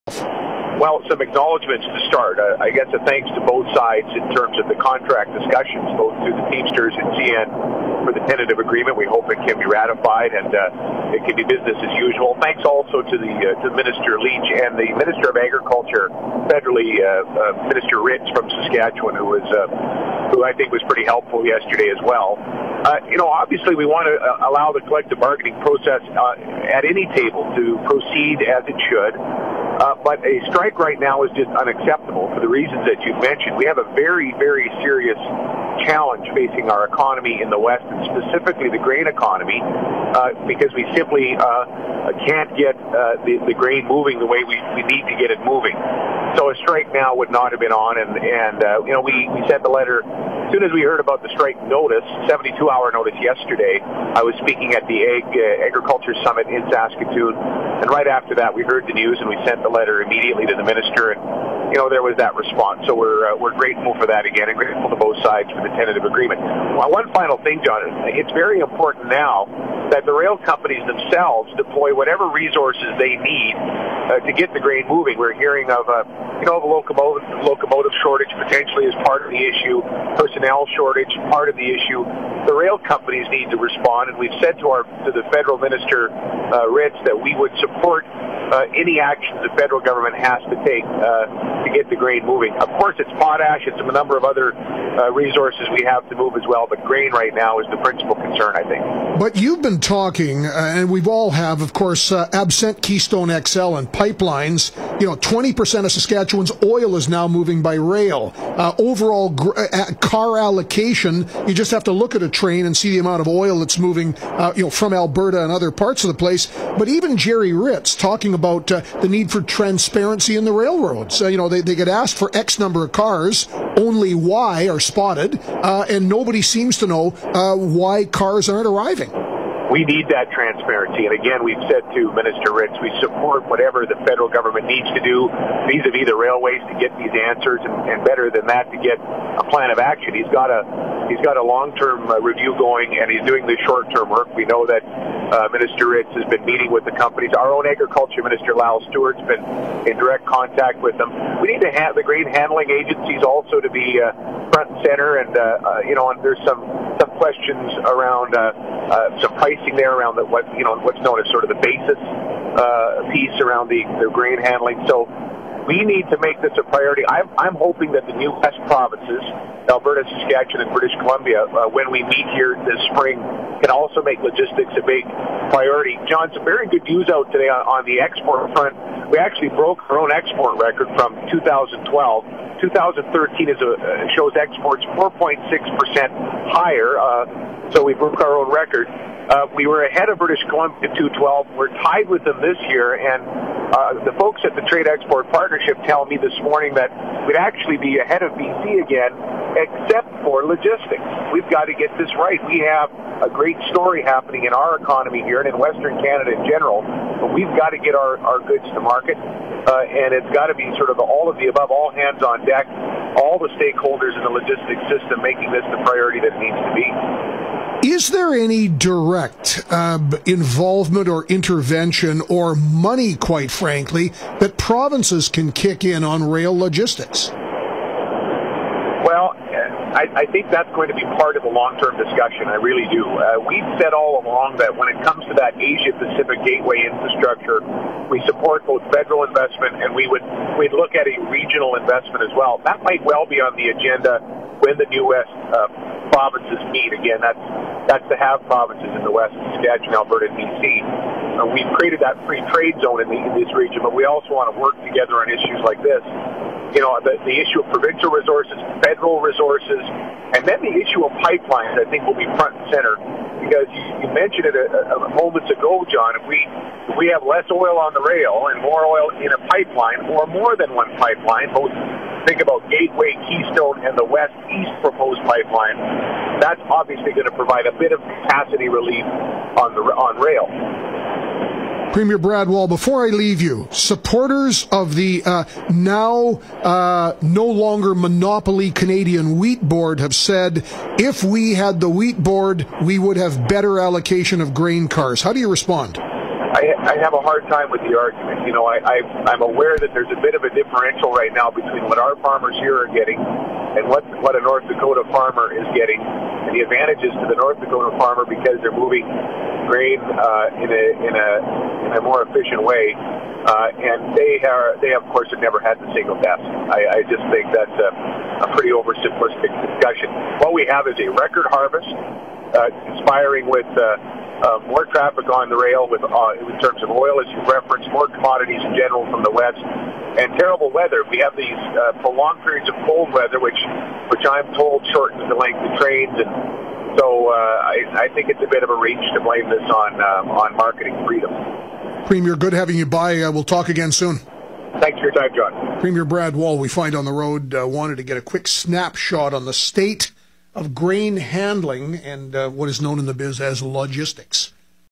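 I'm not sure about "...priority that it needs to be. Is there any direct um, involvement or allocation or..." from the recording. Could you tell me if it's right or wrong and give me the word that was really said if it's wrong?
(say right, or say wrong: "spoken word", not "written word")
wrong: "intervention", not "allocation".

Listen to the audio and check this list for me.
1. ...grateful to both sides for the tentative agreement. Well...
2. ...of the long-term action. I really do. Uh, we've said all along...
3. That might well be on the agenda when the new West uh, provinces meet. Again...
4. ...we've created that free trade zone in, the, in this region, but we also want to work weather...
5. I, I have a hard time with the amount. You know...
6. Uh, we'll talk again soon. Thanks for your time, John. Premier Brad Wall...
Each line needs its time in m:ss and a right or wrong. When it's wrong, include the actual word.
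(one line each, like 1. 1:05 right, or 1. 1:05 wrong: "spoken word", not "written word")
1. 1:04 right
2. 3:51 wrong: "discussion", not "action"
3. 4:02 right
4. 4:11 wrong: "together", not "weather"
5. 4:56 wrong: "argument", not "amount"
6. 5:43 right.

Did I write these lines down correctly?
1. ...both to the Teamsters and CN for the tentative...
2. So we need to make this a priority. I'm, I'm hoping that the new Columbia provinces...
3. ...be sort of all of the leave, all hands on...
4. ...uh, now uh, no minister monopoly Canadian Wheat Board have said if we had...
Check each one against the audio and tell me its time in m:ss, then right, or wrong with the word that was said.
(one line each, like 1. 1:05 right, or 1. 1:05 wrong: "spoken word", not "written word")
1. 0:05 right
2. 2:44 wrong: "West", not "Columbia"
3. 3:30 wrong: "above", not "leave"
4. 4:45 wrong: "longer", not "minister".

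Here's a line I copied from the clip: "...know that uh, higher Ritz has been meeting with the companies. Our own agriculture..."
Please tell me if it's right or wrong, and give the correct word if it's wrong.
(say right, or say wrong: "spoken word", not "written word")
wrong: "minister", not "higher".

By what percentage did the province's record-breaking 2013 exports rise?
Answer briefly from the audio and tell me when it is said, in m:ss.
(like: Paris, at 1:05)
4.6%, at 3:04.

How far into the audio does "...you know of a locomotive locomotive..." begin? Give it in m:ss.
1:16.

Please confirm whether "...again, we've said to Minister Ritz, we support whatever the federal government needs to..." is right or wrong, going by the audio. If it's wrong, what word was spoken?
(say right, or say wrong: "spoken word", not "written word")
right.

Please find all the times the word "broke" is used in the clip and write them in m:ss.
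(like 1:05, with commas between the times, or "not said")
2:59, 3:07.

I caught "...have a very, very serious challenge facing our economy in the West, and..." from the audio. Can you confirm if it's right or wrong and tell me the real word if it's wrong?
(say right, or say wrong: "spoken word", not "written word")
right.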